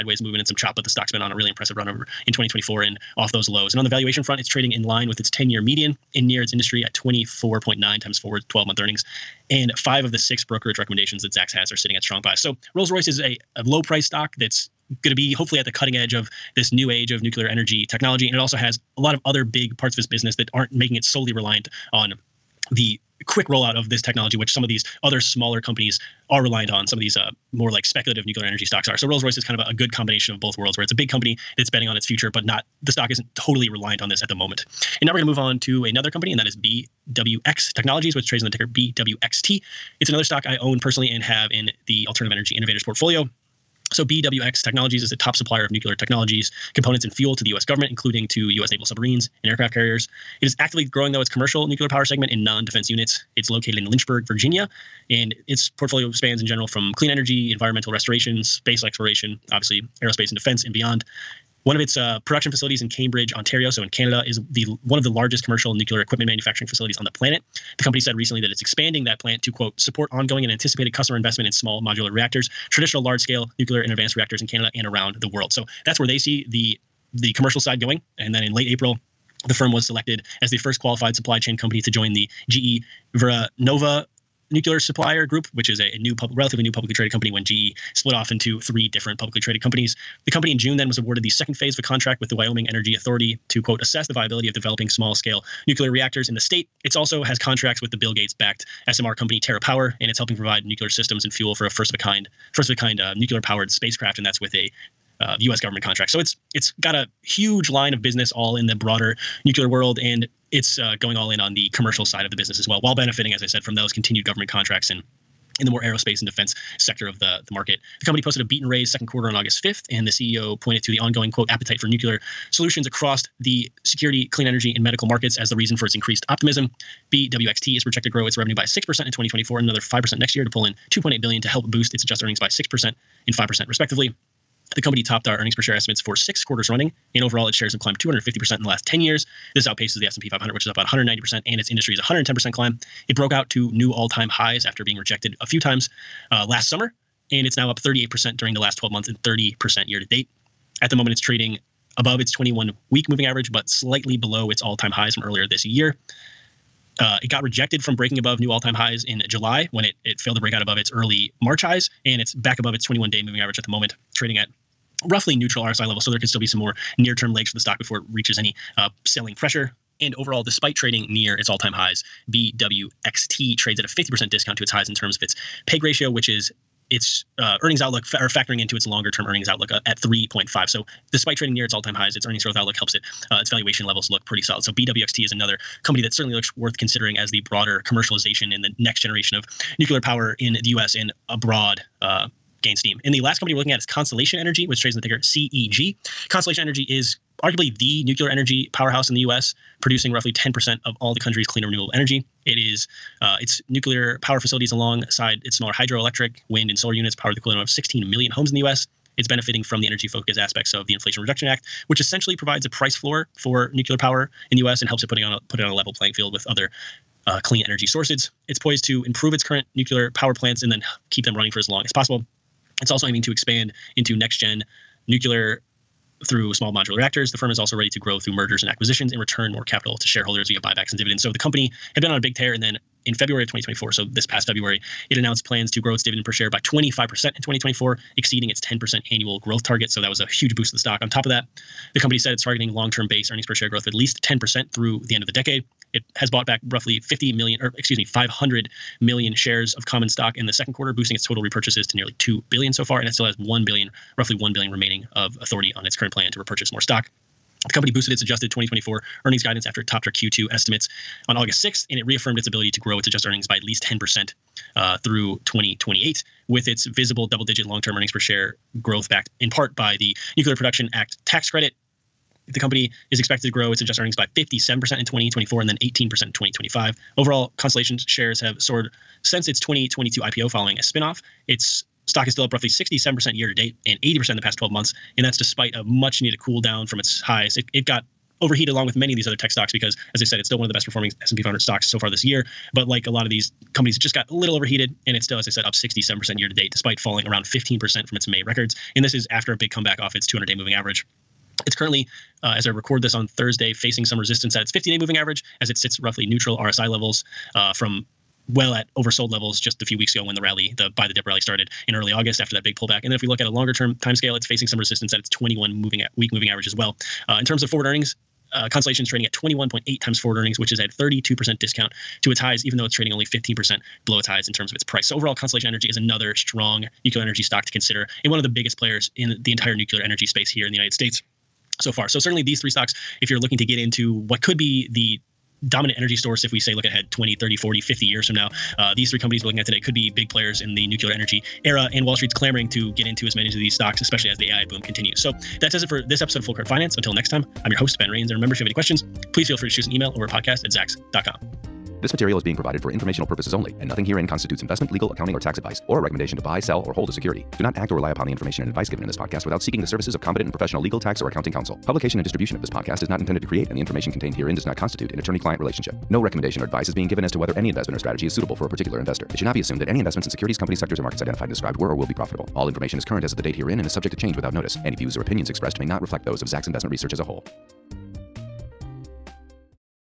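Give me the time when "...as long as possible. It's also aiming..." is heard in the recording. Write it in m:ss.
3:41.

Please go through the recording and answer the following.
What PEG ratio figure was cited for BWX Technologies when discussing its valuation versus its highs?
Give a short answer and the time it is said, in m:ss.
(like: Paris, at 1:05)
3.5, at 2:59.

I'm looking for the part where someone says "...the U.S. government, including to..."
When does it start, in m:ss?
0:47.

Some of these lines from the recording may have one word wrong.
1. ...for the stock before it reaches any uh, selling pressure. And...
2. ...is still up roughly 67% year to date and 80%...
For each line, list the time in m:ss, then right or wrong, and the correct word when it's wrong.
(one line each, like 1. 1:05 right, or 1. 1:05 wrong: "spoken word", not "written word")
1. 2:47 right
2. 4:42 right.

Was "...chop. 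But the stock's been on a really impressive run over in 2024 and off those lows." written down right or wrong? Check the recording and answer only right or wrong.
right.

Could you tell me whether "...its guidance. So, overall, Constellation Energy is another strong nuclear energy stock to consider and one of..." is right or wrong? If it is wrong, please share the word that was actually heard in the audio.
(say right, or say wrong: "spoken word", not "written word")
wrong: "price", not "guidance".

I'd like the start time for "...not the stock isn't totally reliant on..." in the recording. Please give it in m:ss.
0:32.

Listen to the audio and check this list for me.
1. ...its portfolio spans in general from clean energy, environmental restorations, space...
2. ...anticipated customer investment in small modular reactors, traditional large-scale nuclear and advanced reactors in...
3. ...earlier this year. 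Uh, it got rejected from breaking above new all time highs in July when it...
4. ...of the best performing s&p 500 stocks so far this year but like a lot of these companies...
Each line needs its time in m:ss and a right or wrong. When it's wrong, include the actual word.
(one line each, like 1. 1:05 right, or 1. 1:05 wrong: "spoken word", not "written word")
1. 0:55 right
2. 1:10 right
3. 2:35 right
4. 4:50 right.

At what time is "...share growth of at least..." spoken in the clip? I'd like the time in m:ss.
4:03.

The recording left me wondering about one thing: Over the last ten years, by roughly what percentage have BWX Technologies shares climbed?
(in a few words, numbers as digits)
250%.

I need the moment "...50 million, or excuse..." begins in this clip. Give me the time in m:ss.
4:06.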